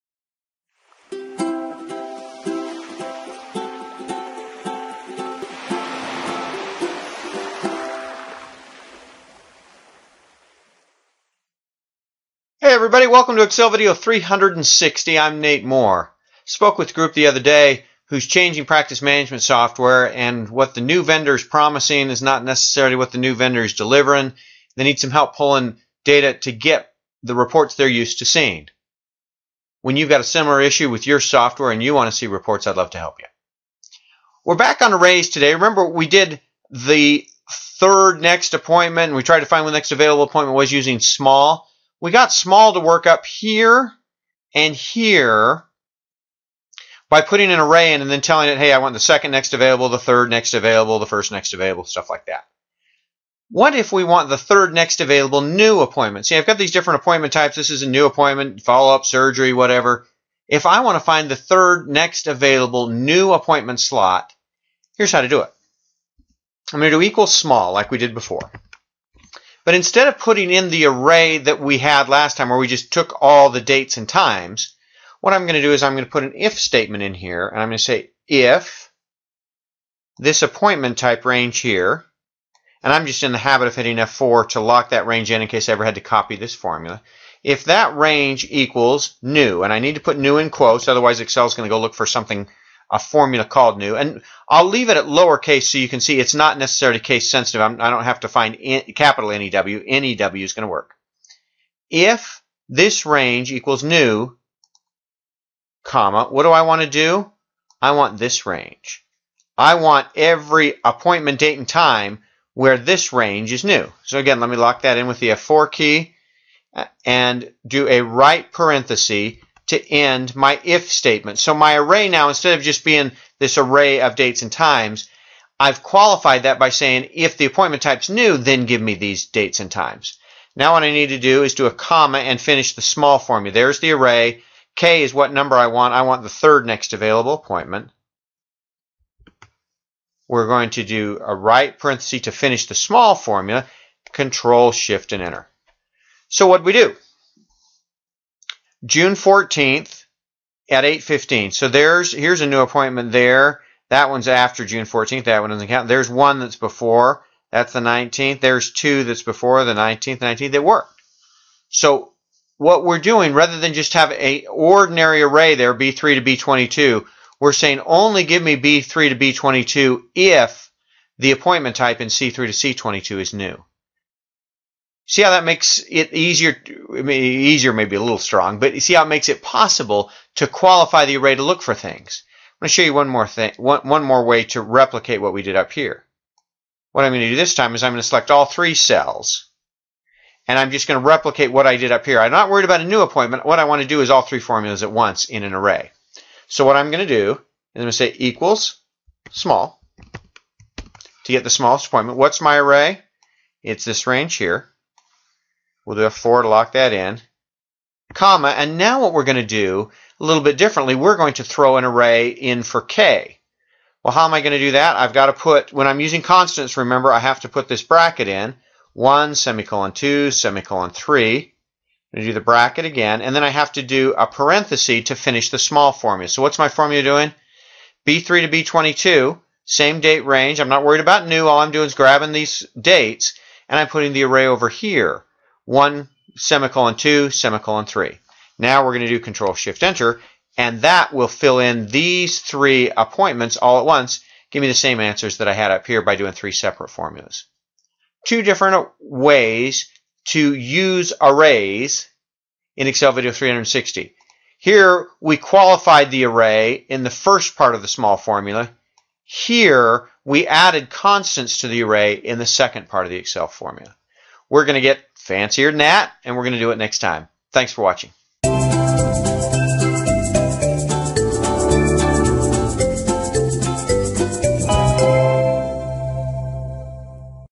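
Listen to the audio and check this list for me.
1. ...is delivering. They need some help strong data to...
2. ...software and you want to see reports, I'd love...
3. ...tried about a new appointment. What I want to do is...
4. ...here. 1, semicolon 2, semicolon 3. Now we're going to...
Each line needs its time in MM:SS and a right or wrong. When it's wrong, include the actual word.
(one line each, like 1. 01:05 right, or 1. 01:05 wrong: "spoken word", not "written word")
1. 00:23 wrong: "pulling", not "strong"
2. 00:31 right
3. 03:12 wrong: "worried", not "tried"
4. 03:54 right.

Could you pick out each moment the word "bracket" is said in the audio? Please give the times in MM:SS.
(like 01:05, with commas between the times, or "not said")
03:37, 03:42.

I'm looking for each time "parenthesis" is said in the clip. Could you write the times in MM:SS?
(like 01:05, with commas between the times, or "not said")
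01:58, 02:21, 03:44.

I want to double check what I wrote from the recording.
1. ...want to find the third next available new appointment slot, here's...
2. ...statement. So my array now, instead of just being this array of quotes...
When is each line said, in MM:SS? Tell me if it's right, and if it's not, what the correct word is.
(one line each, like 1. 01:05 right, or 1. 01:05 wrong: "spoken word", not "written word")
1. 01:00 right
2. 02:00 wrong: "dates", not "quotes".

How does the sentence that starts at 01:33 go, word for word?
And I'll leave it at lowercase so you can see it's not necessarily case sensitive.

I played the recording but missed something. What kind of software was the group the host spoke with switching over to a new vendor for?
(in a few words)
Practice management software.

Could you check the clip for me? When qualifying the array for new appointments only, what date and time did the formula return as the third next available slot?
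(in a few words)
June 14th at 8:15.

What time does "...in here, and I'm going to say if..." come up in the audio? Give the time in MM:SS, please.
01:17.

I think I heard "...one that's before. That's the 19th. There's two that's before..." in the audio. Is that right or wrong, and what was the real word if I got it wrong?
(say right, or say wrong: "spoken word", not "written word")
right.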